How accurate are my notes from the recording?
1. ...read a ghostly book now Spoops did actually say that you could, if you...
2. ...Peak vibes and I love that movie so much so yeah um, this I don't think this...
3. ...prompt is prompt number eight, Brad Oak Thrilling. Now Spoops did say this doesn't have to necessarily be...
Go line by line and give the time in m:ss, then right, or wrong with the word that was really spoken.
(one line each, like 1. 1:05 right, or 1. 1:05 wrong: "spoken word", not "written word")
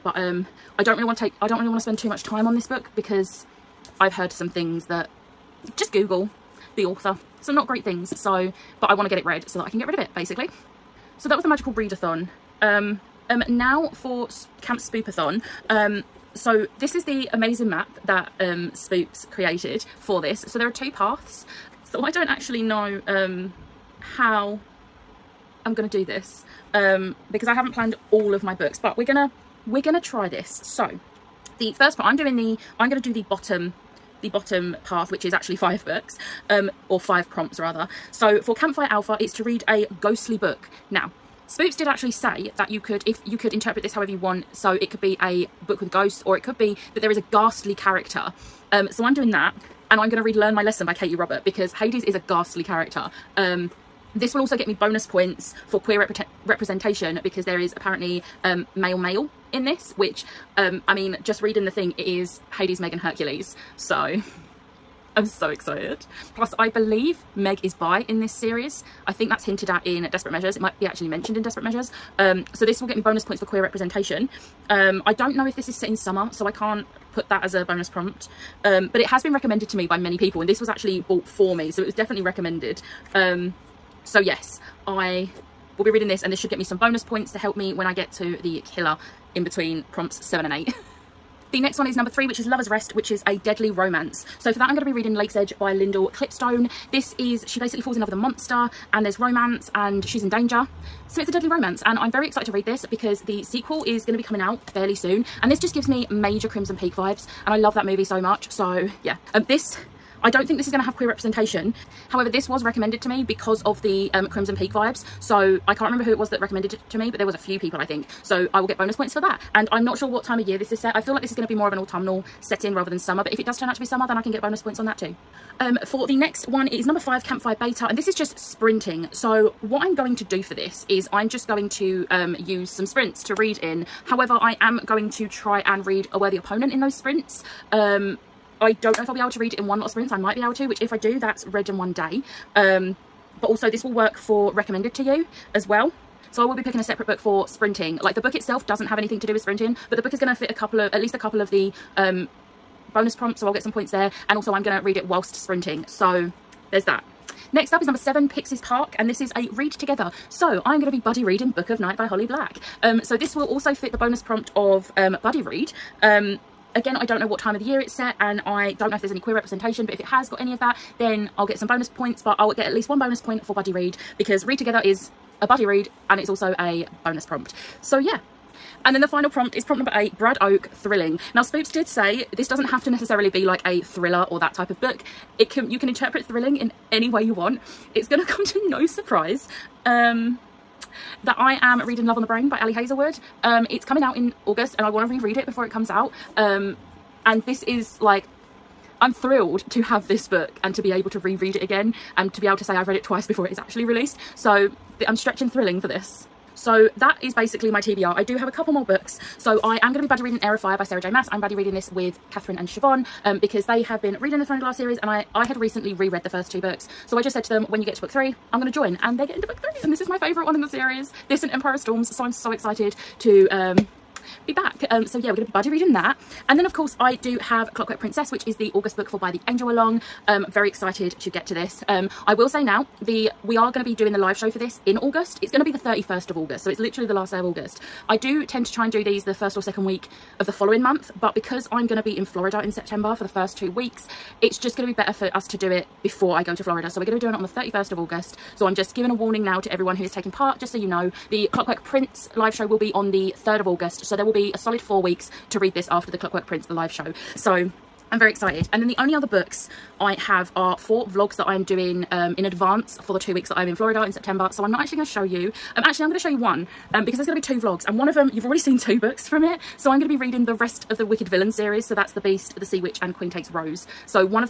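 1. 0:39 right
2. 1:46 right
3. 2:59 right.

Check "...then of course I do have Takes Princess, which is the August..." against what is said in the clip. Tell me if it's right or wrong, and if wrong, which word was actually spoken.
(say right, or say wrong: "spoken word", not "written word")
wrong: "Clockwork", not "Takes".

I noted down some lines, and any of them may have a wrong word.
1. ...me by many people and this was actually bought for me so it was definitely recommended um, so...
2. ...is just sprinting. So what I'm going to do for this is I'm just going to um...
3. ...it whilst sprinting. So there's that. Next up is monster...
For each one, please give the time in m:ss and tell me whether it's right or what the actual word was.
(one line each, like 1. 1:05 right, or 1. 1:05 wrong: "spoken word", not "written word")
1. 1:19 right
2. 2:08 right
3. 2:34 wrong: "number", not "monster".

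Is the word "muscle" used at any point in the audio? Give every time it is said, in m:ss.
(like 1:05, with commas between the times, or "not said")
not said.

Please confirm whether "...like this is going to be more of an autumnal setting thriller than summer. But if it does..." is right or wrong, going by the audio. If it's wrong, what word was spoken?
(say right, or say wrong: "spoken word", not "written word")
wrong: "rather", not "thriller".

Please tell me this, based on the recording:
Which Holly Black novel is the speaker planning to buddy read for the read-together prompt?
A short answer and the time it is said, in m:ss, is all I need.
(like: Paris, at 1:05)
Book of Night, at 2:41.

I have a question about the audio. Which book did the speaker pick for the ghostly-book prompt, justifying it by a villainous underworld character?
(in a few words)
Learn My Lesson.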